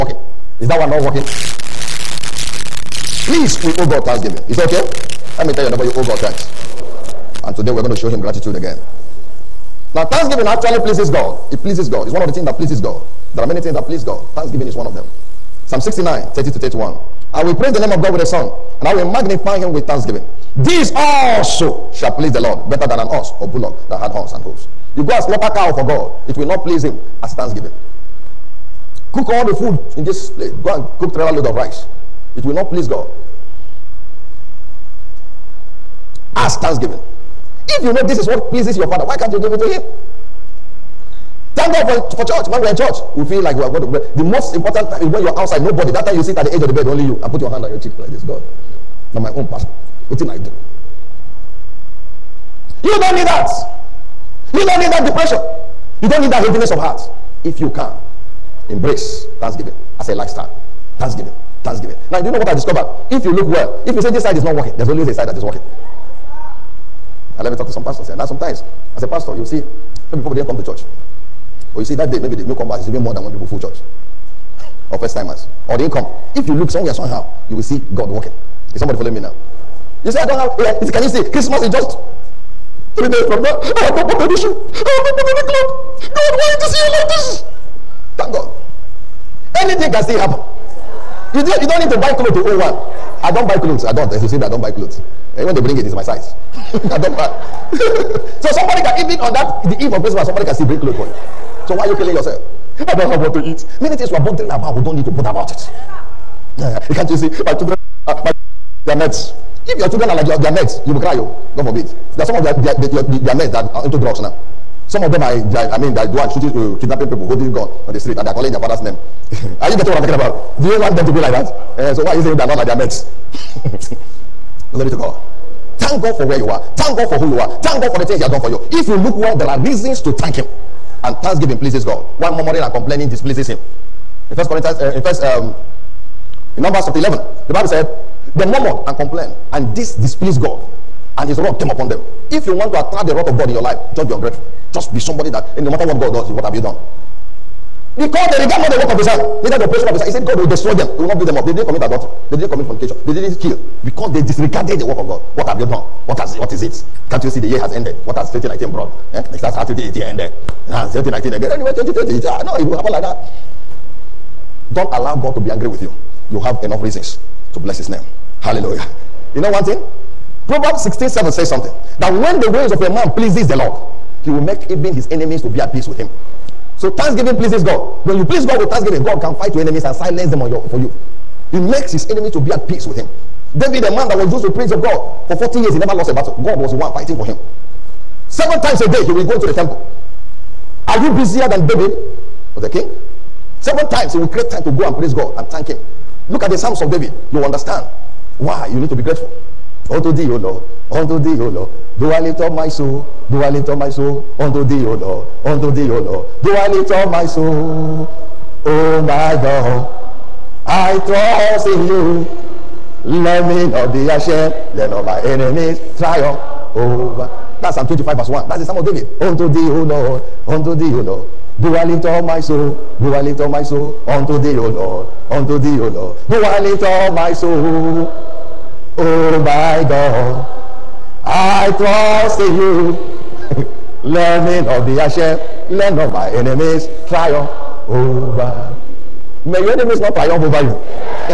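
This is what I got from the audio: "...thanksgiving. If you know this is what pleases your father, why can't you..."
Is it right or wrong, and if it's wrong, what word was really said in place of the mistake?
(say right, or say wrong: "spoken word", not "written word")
right.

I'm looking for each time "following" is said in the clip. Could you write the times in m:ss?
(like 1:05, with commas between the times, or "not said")
1:18.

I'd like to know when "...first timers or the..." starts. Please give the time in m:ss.
1:14.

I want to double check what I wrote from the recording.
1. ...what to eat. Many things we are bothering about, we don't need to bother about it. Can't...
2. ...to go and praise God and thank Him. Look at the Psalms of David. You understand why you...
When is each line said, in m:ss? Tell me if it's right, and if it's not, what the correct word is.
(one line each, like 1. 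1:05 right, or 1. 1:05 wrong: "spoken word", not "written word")
1. 1:43 right
2. 3:14 right.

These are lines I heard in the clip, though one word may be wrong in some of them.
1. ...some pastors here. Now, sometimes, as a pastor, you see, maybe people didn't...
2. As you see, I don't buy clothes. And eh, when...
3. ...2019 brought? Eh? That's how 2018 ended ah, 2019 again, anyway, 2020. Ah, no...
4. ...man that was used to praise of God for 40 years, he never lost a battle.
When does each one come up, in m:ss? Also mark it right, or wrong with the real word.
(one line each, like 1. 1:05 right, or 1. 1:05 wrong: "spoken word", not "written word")
1. 1:07 right
2. 1:34 right
3. 2:38 right
4. 3:03 right.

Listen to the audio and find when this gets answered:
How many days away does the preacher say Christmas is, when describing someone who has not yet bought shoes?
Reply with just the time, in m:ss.
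1:22.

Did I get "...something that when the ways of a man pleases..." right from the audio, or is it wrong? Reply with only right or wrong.
right.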